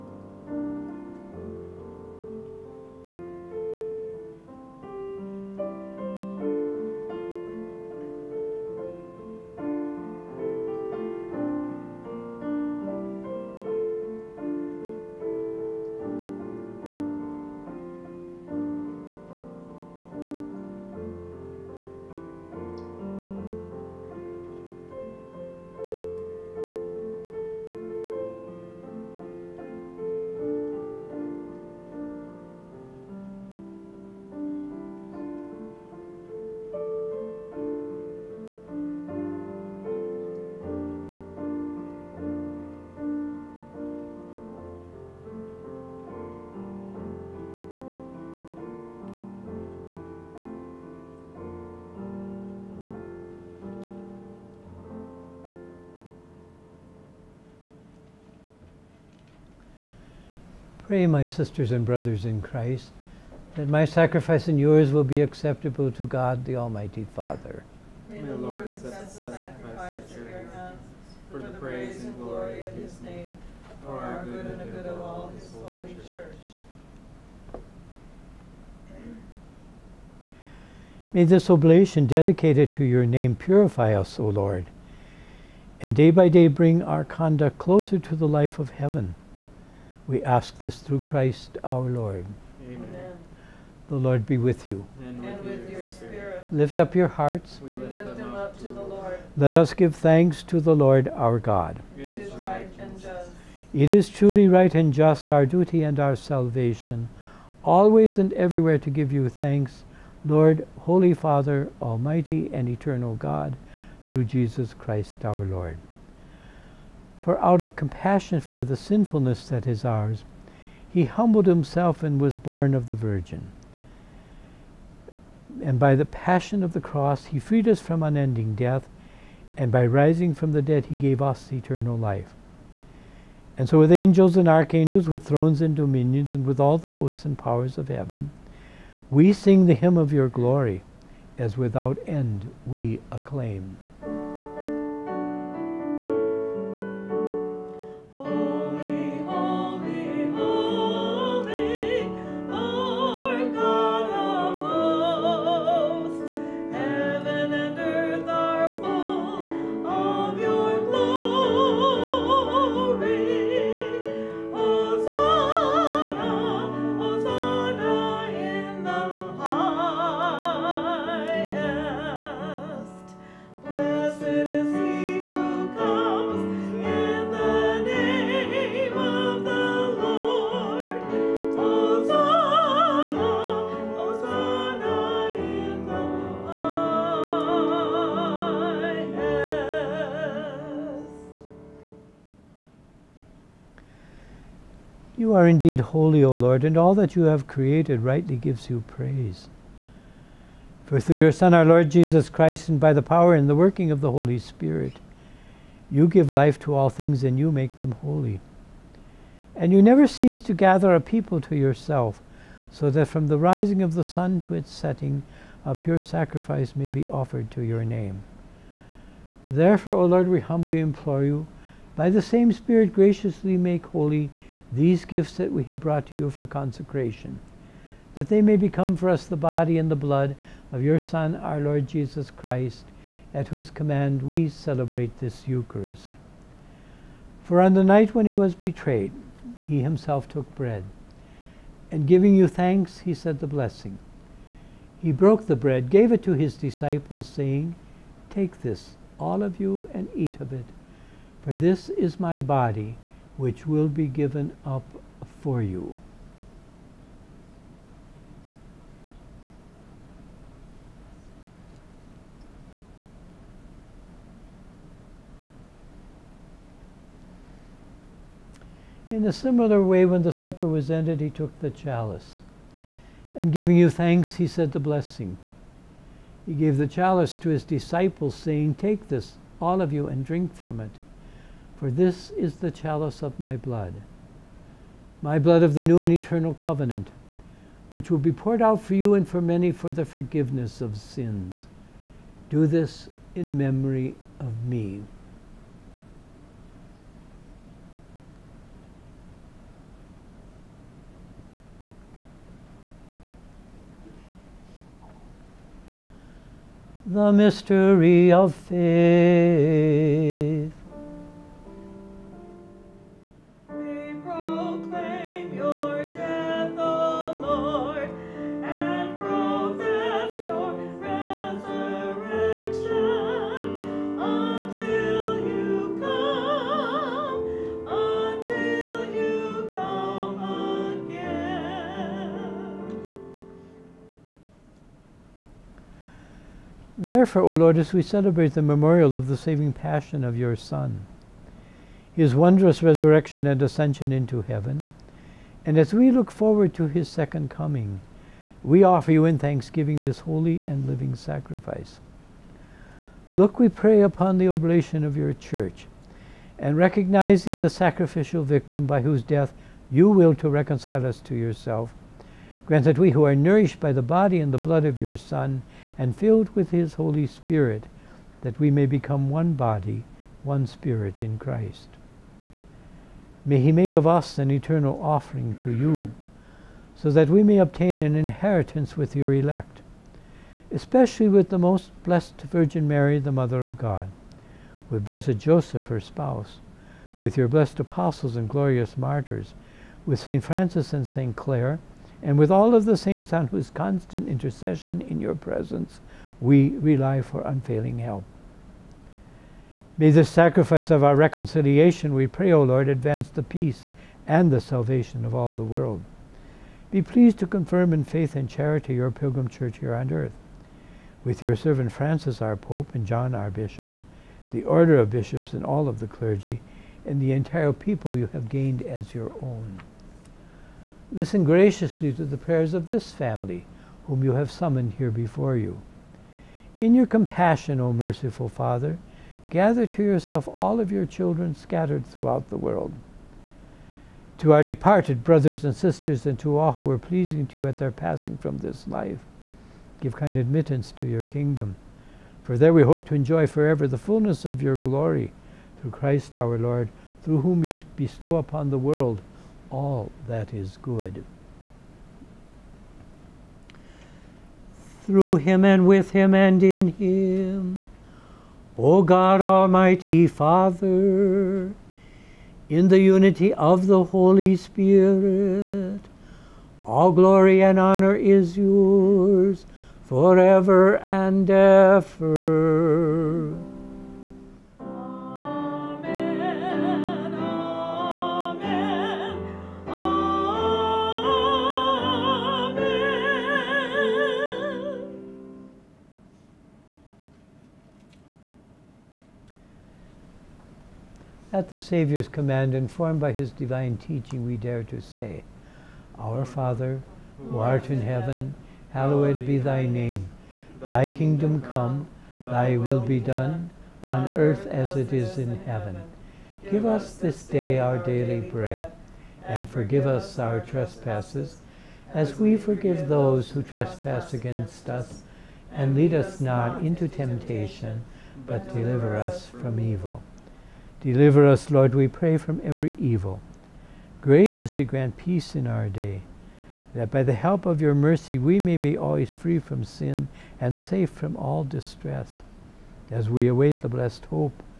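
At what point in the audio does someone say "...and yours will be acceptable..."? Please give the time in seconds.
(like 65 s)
64 s.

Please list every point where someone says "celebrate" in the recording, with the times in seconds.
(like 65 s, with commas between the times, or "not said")
234 s, 338 s.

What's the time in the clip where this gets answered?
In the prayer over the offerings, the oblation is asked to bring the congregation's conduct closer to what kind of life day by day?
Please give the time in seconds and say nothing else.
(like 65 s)
88 s.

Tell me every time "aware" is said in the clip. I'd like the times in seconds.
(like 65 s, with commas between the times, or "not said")
not said.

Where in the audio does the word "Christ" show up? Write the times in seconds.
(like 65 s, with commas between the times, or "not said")
62 s, 90 s, 114 s, 202 s, 232 s, 371 s, 445 s.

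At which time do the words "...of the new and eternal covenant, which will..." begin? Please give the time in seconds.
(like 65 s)
285 s.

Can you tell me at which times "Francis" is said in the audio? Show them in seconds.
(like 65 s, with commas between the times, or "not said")
390 s, 411 s.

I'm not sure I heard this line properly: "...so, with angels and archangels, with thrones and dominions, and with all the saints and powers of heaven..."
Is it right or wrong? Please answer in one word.
wrong.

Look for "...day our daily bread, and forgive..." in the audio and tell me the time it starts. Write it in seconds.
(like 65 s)
507 s.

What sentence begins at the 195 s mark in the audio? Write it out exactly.
are indeed holy, O Lord, and all that you have created rightly gives you praise.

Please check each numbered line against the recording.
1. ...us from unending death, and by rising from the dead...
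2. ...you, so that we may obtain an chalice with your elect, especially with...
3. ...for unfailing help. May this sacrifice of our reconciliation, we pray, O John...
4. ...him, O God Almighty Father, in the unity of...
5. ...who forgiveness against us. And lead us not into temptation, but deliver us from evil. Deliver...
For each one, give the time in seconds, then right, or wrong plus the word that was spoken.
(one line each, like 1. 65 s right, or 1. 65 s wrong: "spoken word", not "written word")
1. 127 s right
2. 375 s wrong: "inheritance", not "chalice"
3. 397 s wrong: "Lord", not "John"
4. 456 s right
5. 513 s wrong: "trespass", not "forgiveness".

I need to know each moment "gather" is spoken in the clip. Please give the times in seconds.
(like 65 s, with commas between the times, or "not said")
210 s, 429 s.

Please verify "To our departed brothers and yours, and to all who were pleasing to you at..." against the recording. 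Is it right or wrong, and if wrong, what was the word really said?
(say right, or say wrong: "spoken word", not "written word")
wrong: "sisters", not "yours".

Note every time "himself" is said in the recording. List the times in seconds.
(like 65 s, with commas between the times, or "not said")
121 s, 239 s.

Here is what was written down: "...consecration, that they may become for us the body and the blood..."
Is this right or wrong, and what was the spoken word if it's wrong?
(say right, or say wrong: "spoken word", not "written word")
right.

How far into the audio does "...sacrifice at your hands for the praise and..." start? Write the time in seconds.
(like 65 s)
69 s.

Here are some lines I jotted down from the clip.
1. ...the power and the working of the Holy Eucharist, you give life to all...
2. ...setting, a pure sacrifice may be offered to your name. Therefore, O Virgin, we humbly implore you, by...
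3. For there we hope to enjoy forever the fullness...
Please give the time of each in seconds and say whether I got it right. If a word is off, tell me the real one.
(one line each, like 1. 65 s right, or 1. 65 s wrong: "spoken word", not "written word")
1. 202 s wrong: "Spirit", not "Eucharist"
2. 214 s wrong: "Lord", not "Virgin"
3. 442 s right.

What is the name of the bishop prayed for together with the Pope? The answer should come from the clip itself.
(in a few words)
John.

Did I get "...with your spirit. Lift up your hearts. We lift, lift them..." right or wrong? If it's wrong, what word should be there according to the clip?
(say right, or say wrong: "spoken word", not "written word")
right.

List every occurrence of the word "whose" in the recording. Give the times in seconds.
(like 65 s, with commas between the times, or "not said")
233 s, 359 s, 393 s.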